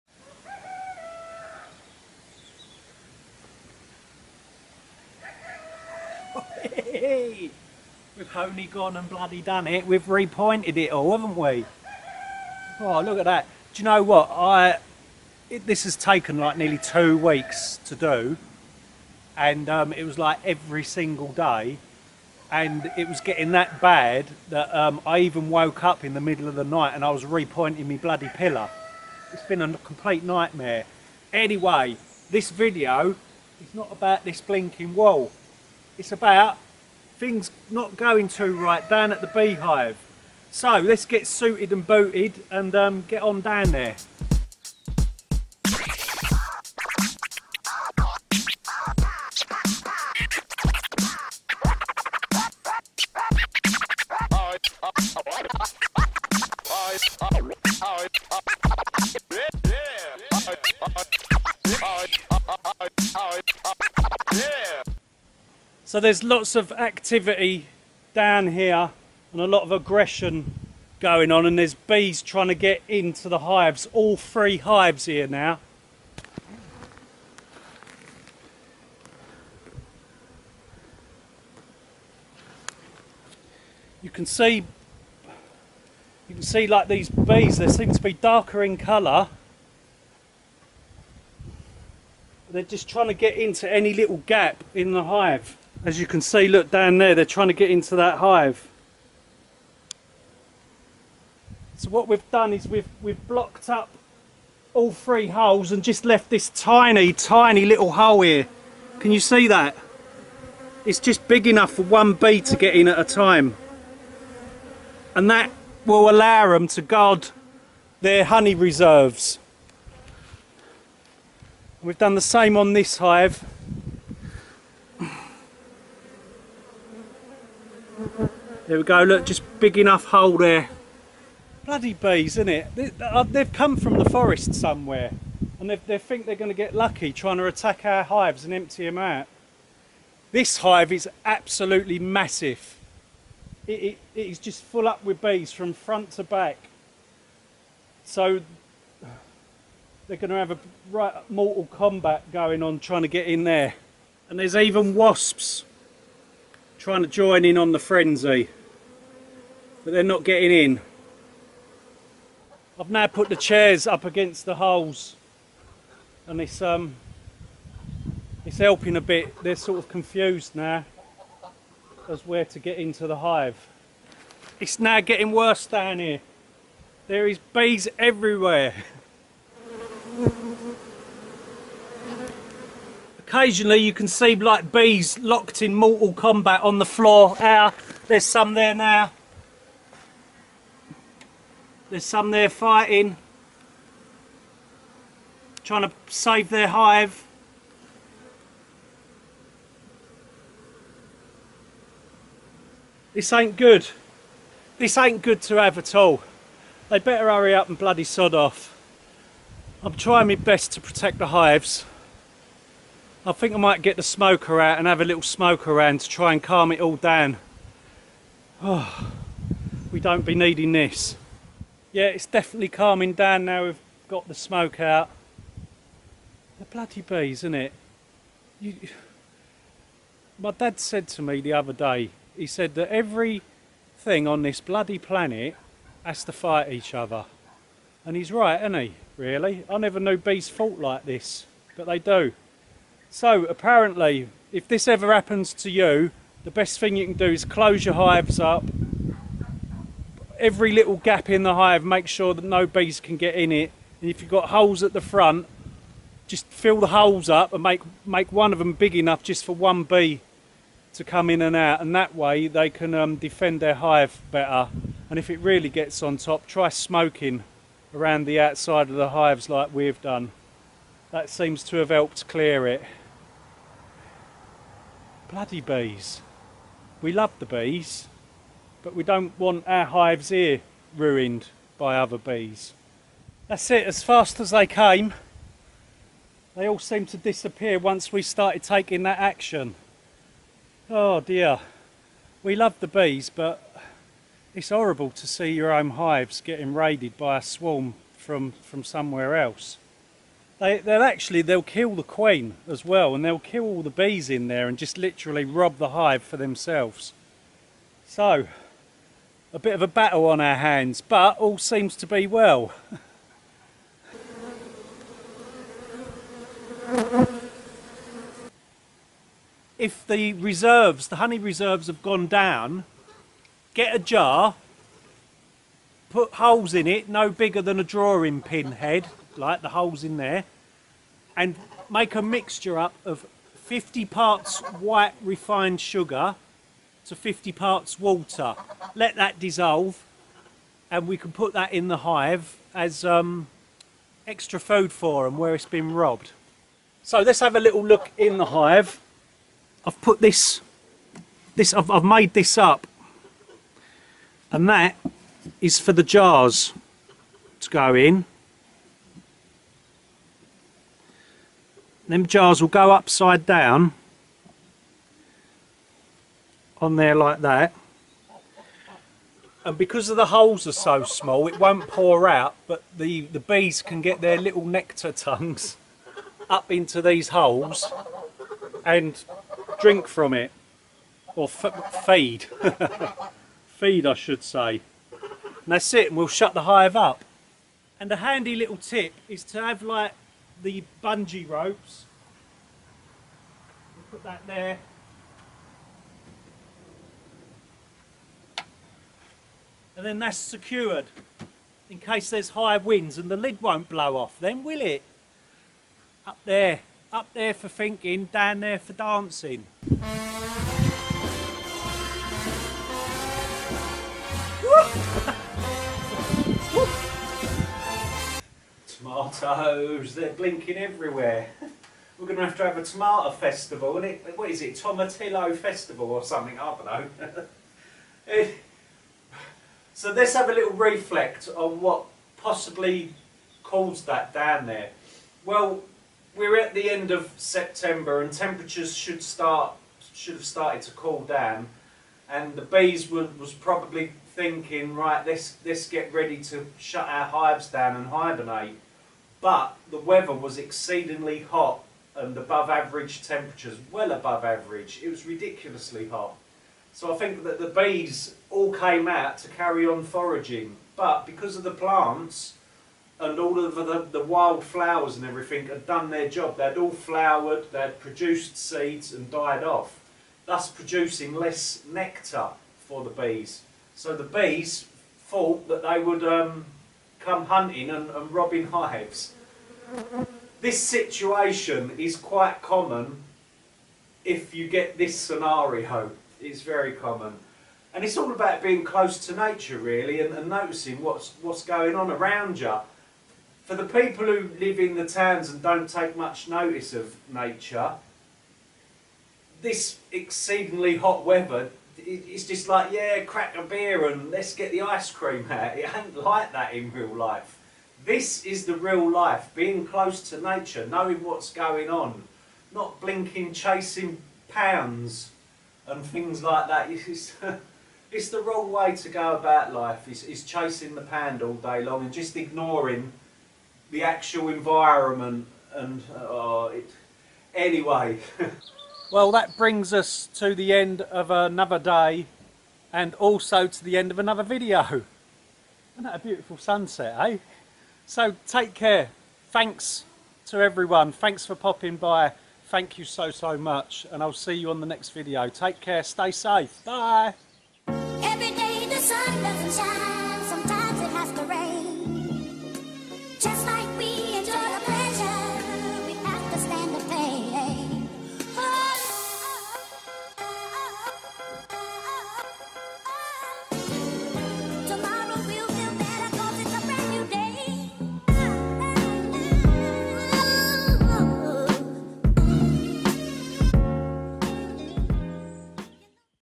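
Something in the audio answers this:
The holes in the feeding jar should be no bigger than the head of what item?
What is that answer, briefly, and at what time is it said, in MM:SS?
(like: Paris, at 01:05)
drawing pin, at 05:27.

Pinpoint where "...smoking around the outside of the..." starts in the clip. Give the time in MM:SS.
04:26.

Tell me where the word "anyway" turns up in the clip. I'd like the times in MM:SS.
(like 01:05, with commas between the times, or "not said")
00:31, 08:47.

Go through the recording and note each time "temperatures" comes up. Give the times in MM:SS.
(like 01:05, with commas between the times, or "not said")
07:18, 07:33.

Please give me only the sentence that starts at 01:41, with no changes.
So what we've done is we've, we've blocked up all three holes and just left this tiny, tiny little hole here.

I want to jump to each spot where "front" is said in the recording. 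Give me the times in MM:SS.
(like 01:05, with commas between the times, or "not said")
02:25, 04:15.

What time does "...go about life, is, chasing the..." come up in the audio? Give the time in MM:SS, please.
08:39.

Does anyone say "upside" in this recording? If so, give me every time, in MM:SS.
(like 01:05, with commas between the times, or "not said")
06:02.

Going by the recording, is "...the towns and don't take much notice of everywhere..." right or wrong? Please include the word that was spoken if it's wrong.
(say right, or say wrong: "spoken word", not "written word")
wrong: "nature", not "everywhere".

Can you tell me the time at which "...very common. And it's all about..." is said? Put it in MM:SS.
08:06.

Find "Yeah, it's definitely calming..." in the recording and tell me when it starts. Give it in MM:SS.
03:41.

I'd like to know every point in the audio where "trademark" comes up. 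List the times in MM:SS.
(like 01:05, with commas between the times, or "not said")
not said.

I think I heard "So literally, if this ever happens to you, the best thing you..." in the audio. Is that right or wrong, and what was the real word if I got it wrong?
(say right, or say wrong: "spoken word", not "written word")
wrong: "apparently", not "literally".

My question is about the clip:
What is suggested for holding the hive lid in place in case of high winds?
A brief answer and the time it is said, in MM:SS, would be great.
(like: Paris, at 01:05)
bungee ropes, at 06:31.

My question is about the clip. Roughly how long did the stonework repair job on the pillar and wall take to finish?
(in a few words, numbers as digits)
nearly two weeks.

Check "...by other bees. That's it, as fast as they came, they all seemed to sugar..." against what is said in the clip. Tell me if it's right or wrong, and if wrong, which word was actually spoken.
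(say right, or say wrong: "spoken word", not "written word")
wrong: "disappear", not "sugar".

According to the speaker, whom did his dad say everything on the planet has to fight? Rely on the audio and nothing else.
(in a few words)
each other.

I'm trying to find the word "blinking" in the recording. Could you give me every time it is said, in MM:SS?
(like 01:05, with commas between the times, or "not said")
00:34, 07:00, 08:32.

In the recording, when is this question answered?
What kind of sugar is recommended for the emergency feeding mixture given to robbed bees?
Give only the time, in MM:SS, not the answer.
05:34.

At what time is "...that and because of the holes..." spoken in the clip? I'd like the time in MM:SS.
06:07.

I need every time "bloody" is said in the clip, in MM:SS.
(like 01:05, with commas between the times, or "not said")
00:09, 00:27, 02:11, 03:27, 03:46, 03:54, 04:35.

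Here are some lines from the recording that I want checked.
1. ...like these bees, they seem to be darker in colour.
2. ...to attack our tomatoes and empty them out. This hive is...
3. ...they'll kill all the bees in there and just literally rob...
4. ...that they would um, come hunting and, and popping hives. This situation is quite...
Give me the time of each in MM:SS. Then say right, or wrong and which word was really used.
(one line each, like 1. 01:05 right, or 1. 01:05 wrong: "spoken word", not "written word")
1. 01:26 right
2. 02:17 wrong: "hives", not "tomatoes"
3. 05:03 right
4. 07:55 wrong: "robbing", not "popping".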